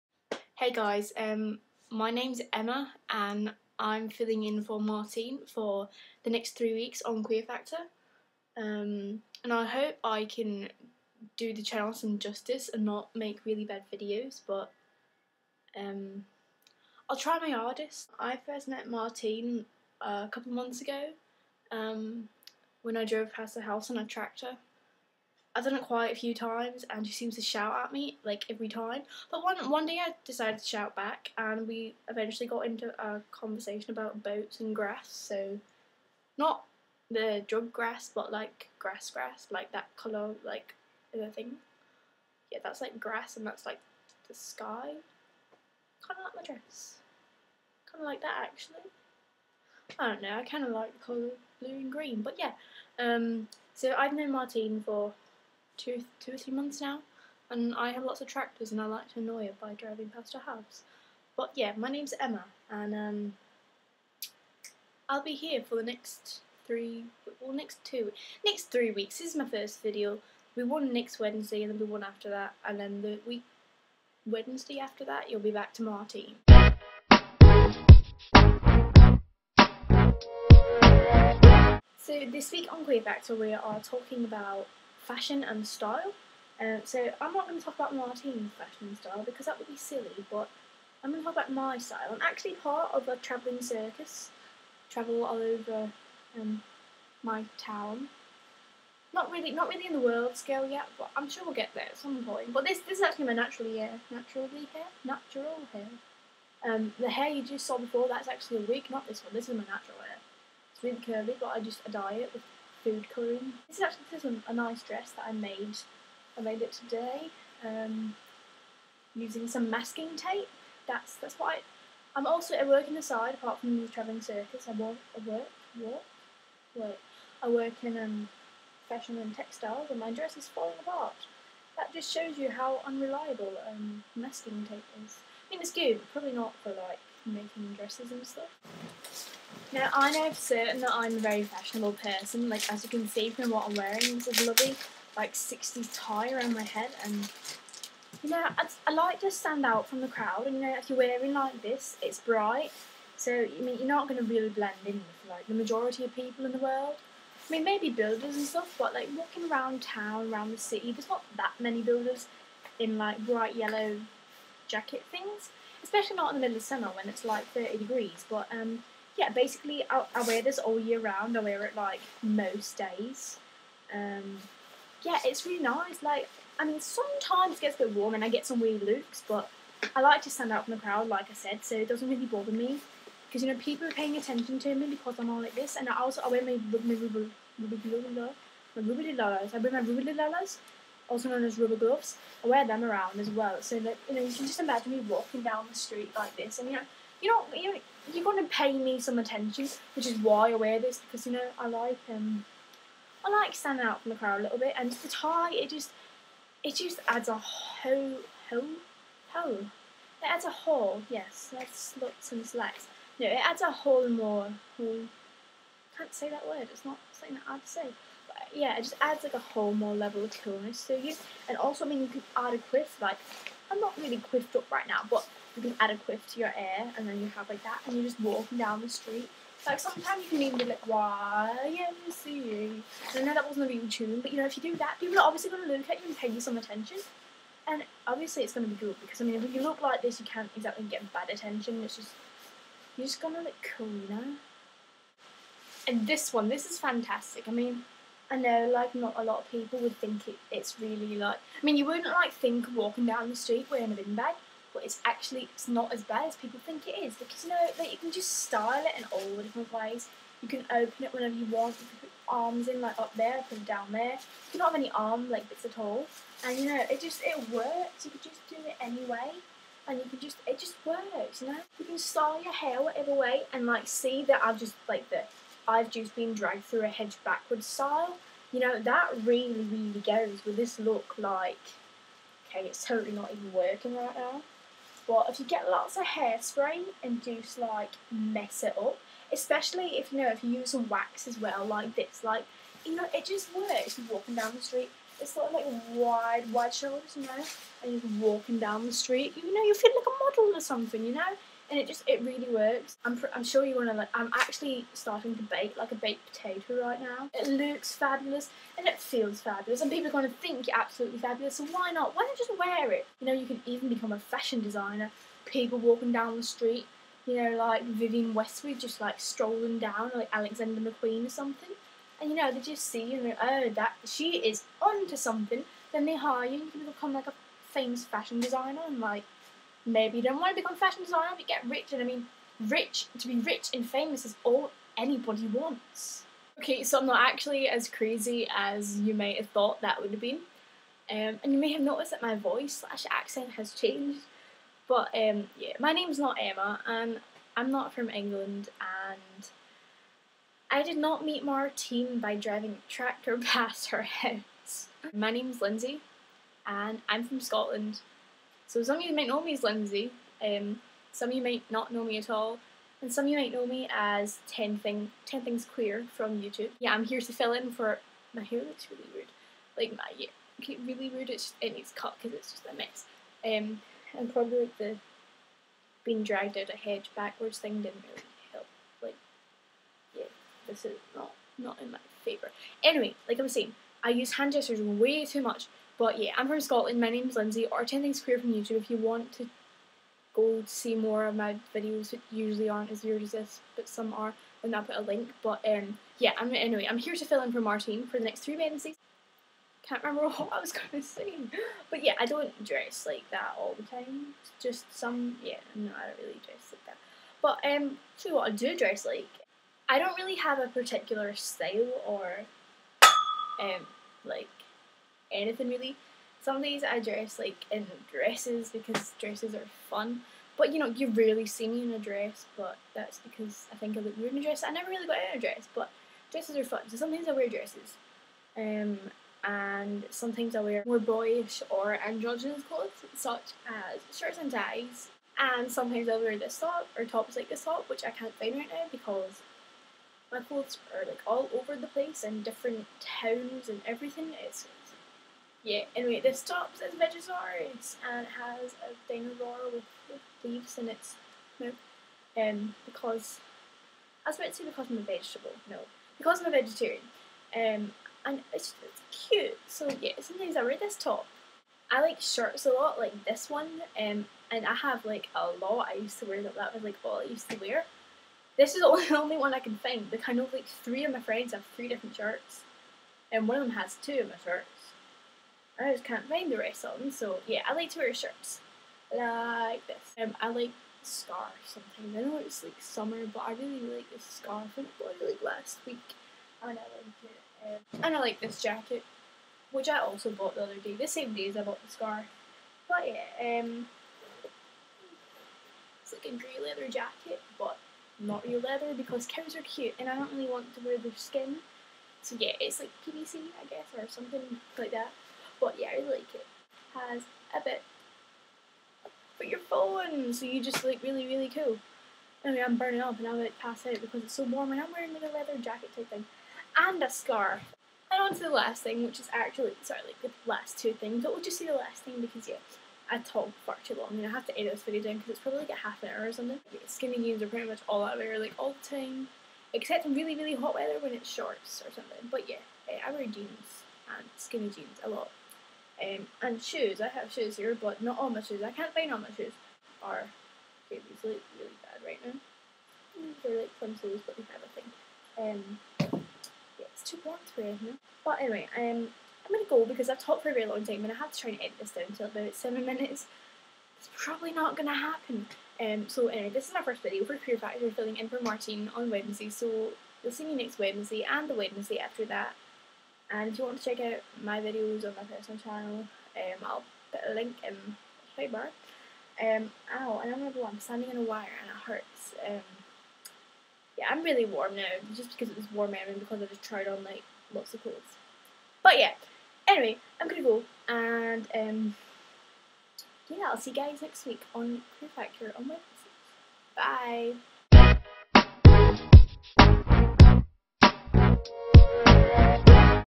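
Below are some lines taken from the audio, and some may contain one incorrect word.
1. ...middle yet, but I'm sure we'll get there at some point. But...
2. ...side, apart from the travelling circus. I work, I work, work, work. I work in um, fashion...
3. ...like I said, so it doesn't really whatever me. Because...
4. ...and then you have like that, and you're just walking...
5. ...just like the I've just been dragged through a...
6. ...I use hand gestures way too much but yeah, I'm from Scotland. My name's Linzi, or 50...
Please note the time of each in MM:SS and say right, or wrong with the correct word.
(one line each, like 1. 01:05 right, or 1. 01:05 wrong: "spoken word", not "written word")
1. 01:40 wrong: "scale", not "middle"
2. 02:03 right
3. 03:01 wrong: "bother", not "whatever"
4. 03:46 right
5. 04:34 right
6. 06:24 wrong: "10", not "50".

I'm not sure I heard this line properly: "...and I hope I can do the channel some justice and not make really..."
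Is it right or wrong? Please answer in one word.
right.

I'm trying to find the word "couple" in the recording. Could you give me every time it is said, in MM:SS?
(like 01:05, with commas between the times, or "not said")
00:20.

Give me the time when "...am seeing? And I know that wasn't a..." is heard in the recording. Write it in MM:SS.
03:51.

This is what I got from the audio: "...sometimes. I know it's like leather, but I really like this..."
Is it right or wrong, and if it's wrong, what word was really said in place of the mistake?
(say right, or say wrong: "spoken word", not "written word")
wrong: "summer", not "leather".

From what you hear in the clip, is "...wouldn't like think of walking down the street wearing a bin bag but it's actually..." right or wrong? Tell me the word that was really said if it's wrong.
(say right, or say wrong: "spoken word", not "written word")
right.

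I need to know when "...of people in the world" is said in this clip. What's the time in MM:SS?
02:36.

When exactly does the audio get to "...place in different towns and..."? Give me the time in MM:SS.
07:21.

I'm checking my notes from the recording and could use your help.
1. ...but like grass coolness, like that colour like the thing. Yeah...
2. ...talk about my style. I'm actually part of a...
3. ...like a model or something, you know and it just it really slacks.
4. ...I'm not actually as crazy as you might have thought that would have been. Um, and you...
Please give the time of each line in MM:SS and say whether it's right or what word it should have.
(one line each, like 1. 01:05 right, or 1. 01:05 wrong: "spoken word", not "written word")
1. 00:38 wrong: "grass", not "coolness"
2. 01:31 right
3. 04:59 wrong: "works", not "slacks"
4. 05:36 right.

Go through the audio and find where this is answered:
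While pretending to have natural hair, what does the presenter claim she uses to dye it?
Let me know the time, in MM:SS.
01:52.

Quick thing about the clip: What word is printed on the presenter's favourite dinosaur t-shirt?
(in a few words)
Vegisaurus.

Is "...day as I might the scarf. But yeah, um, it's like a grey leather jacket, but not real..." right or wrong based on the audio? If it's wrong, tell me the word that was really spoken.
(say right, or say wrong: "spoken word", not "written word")
wrong: "bought", not "might".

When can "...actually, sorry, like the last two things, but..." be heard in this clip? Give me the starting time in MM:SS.
08:39.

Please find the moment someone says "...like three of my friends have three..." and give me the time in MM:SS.
07:50.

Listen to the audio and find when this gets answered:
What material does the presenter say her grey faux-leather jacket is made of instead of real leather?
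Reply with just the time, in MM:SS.
08:23.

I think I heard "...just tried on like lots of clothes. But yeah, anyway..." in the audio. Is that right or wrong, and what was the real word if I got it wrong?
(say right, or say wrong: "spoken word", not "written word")
right.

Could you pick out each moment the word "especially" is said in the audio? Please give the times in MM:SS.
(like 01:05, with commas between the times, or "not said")
02:45, 04:49.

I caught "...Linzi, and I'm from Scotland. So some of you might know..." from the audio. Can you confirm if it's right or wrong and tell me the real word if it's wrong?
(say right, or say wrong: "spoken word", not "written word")
right.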